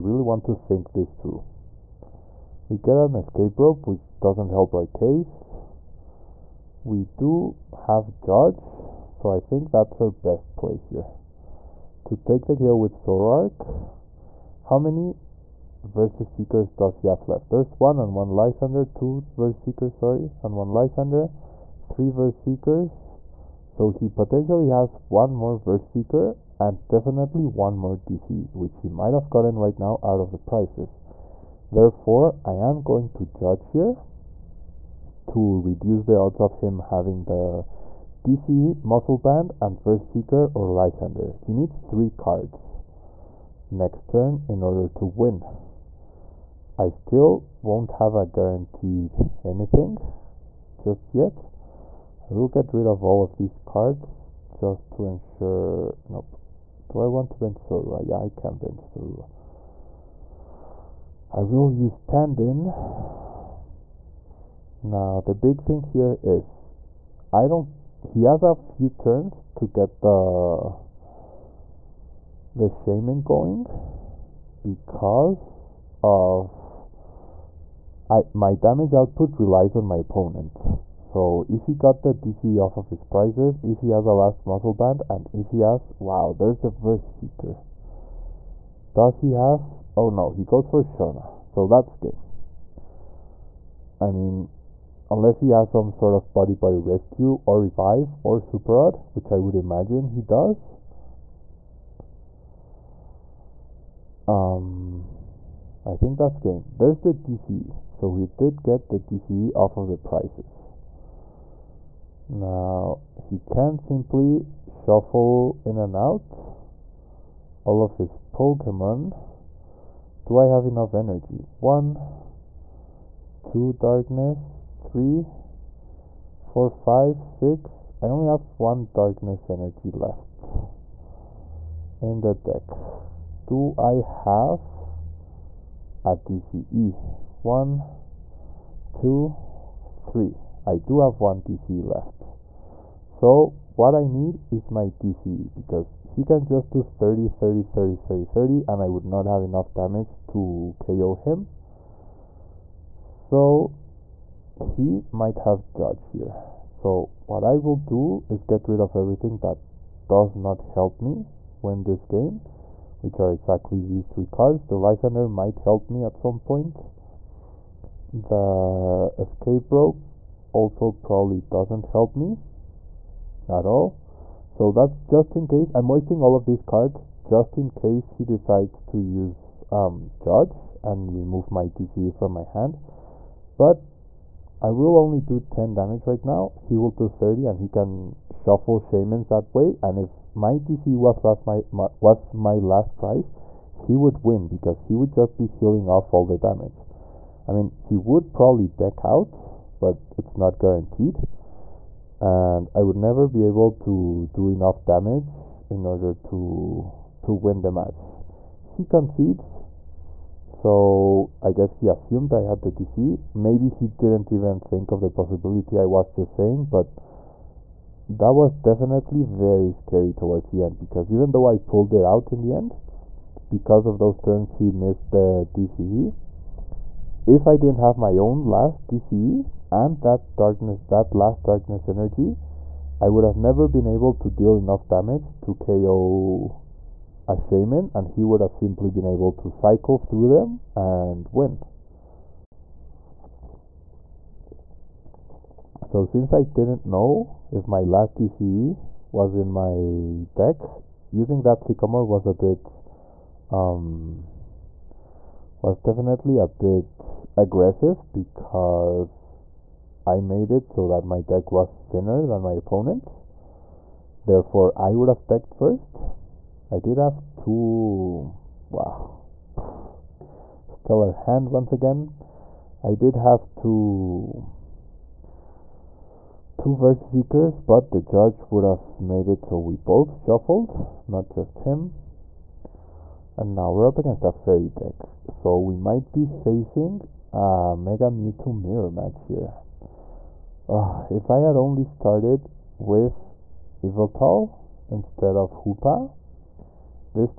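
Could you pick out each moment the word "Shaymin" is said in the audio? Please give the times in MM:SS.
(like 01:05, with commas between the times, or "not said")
01:12, 03:08, 03:57.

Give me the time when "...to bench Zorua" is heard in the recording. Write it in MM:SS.
00:57.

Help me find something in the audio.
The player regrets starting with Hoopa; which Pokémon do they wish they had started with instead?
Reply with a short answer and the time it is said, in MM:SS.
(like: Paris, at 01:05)
Yveltal, at 04:53.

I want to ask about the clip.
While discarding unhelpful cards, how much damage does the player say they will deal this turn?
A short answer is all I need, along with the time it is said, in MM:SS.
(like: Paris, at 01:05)
10, at 03:05.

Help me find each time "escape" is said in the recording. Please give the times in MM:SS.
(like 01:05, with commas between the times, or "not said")
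00:03, 02:49.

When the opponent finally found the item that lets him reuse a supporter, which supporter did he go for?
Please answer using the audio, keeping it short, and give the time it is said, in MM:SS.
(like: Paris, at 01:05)
Shauna, at 01:30.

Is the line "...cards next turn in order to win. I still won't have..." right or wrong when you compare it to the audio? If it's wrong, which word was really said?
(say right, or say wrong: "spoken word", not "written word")
right.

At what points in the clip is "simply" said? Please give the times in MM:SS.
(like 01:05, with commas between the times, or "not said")
01:53, 03:58.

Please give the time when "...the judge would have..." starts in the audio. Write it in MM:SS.
04:37.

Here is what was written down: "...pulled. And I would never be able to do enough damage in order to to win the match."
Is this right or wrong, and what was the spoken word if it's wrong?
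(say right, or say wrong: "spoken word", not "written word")
wrong: "guaranteed", not "pulled".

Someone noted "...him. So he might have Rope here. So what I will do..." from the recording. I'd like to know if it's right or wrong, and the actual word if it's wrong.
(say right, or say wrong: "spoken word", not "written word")
wrong: "Judge", not "Rope".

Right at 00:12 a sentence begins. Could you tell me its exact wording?
To take the kill with Zoroark, how many VS Seekers does he have left?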